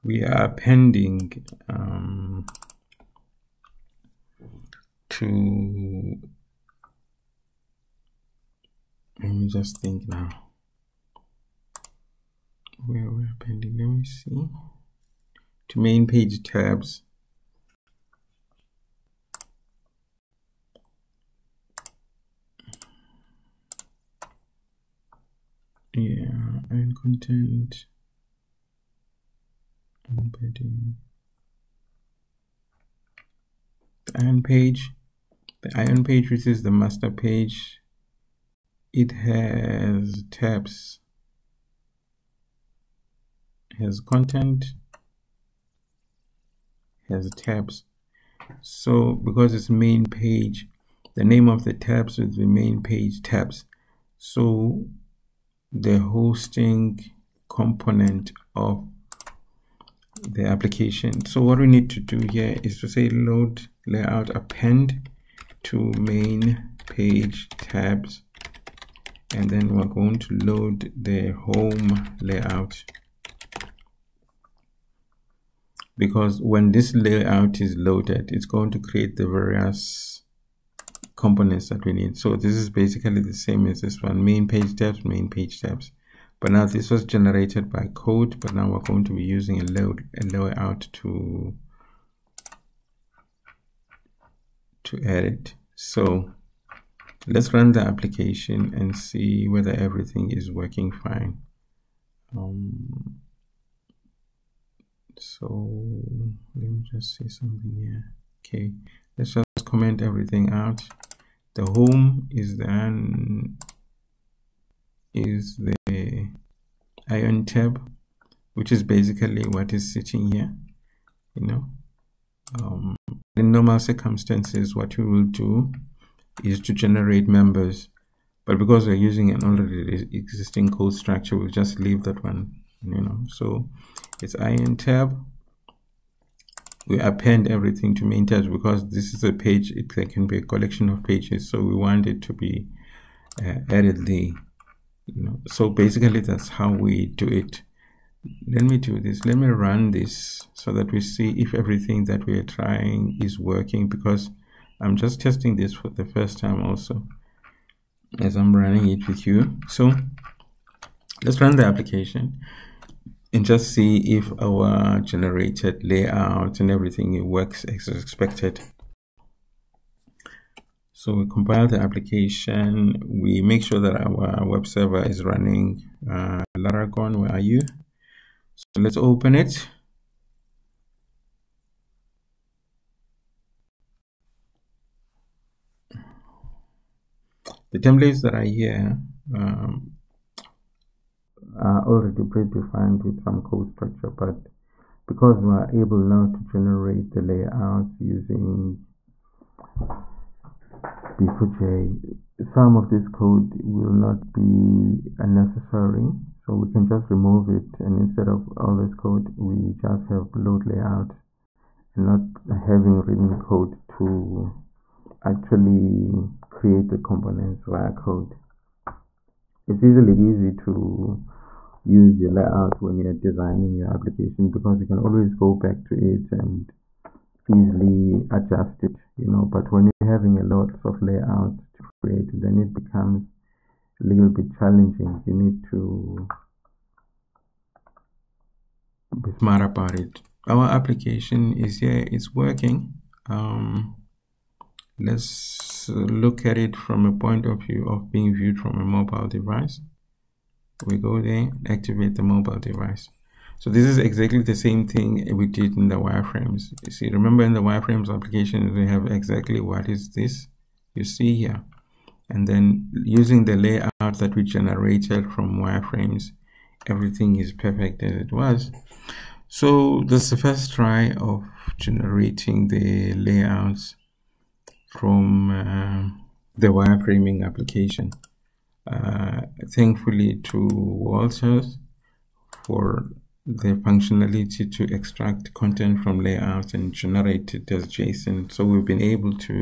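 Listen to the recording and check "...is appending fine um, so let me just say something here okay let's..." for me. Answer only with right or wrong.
wrong.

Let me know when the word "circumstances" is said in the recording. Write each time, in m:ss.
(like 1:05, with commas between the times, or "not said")
2:03.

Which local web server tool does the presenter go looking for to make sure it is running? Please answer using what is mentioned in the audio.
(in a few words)
Laragon.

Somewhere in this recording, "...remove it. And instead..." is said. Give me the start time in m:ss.
3:27.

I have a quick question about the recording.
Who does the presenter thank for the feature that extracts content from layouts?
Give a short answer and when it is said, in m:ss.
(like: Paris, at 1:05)
Walters, at 4:40.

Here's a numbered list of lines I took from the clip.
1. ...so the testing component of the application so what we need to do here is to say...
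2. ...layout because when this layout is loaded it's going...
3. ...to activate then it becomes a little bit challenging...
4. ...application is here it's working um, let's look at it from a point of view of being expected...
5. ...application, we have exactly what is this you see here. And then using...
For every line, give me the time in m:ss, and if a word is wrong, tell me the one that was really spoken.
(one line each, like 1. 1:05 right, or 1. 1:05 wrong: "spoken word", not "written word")
1. 0:54 wrong: "hosting", not "testing"
2. 1:12 right
3. 3:51 wrong: "create", not "activate"
4. 4:00 wrong: "viewed", not "expected"
5. 4:18 right.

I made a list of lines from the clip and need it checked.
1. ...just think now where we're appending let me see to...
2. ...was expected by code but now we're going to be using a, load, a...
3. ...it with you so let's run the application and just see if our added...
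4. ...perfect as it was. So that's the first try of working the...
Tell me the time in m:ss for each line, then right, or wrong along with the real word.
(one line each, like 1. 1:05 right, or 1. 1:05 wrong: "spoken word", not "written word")
1. 0:09 right
2. 1:26 wrong: "generated", not "expected"
3. 2:38 wrong: "generated", not "added"
4. 4:27 wrong: "generating", not "working".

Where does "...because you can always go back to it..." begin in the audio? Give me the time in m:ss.
3:44.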